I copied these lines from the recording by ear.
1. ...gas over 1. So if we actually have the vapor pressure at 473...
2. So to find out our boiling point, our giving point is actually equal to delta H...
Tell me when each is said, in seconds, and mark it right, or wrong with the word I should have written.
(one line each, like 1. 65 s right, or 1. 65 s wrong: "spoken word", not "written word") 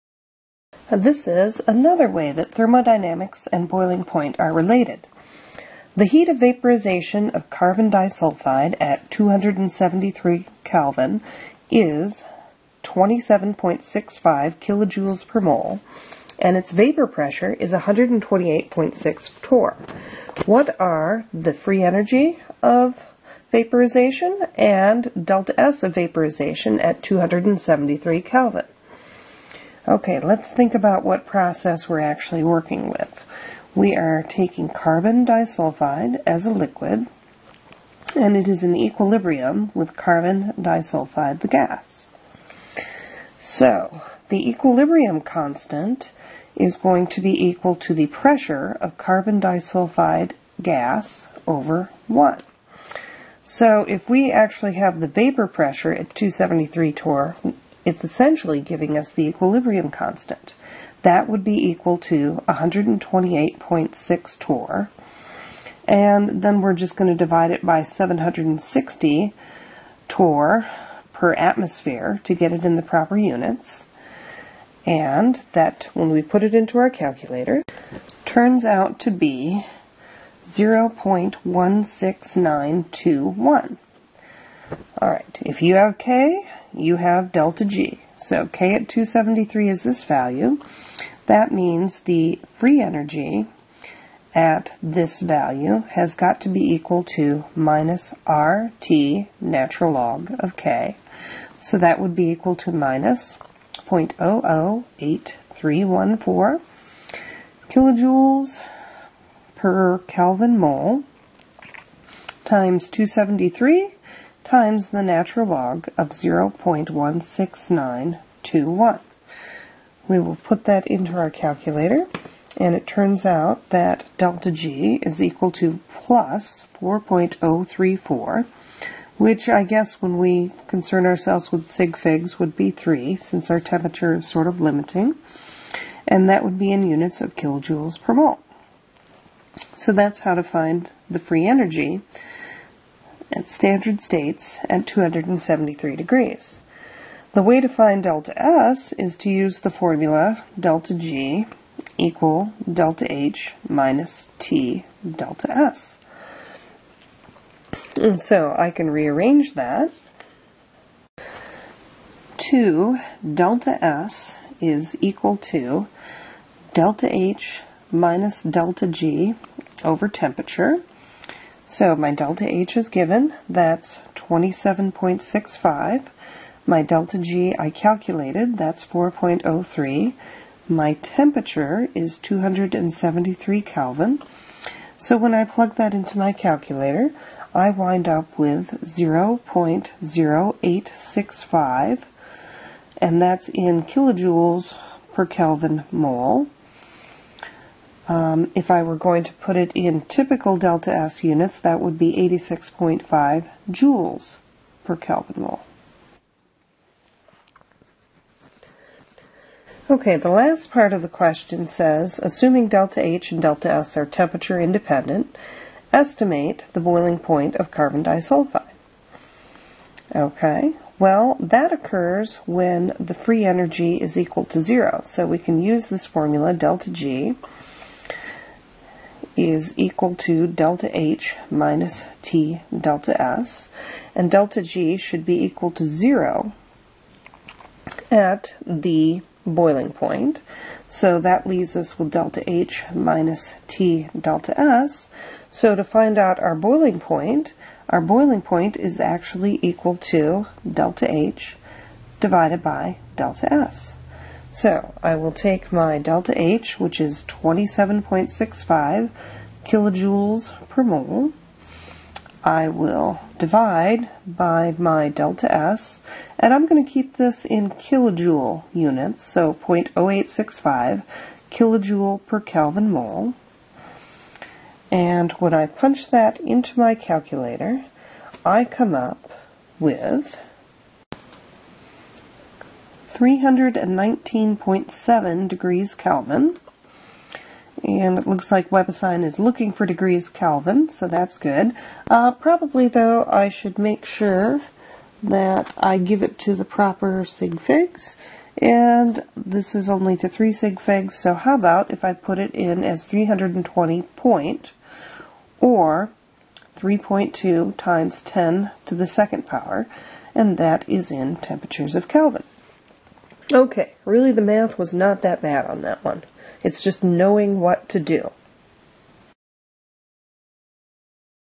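1. 50 s wrong: "273", not "473"
2. 245 s wrong: "boiling", not "giving".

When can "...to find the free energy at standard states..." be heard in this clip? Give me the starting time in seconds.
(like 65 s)
140 s.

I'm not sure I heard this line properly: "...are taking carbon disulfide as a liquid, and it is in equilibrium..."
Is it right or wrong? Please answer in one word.
right.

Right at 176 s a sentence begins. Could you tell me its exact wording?
My delta G I calculated, that's 4.03.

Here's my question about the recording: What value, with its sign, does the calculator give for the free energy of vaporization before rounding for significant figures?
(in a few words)
+4.034.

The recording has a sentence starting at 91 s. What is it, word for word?
That means the free energy at this value has got to be equal to minus RT natural log of K.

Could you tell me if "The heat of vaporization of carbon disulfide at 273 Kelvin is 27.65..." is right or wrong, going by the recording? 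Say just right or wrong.
right.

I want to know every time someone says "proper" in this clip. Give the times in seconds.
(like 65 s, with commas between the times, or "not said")
72 s, 296 s.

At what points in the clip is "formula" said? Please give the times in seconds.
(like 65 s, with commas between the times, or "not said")
149 s, 226 s.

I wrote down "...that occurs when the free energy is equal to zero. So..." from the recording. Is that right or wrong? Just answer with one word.
right.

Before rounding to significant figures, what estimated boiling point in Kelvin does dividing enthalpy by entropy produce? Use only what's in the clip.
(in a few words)
319.7 K.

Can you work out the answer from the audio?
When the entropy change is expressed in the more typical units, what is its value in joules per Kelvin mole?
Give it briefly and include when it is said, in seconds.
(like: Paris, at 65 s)
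86.5, at 202 s.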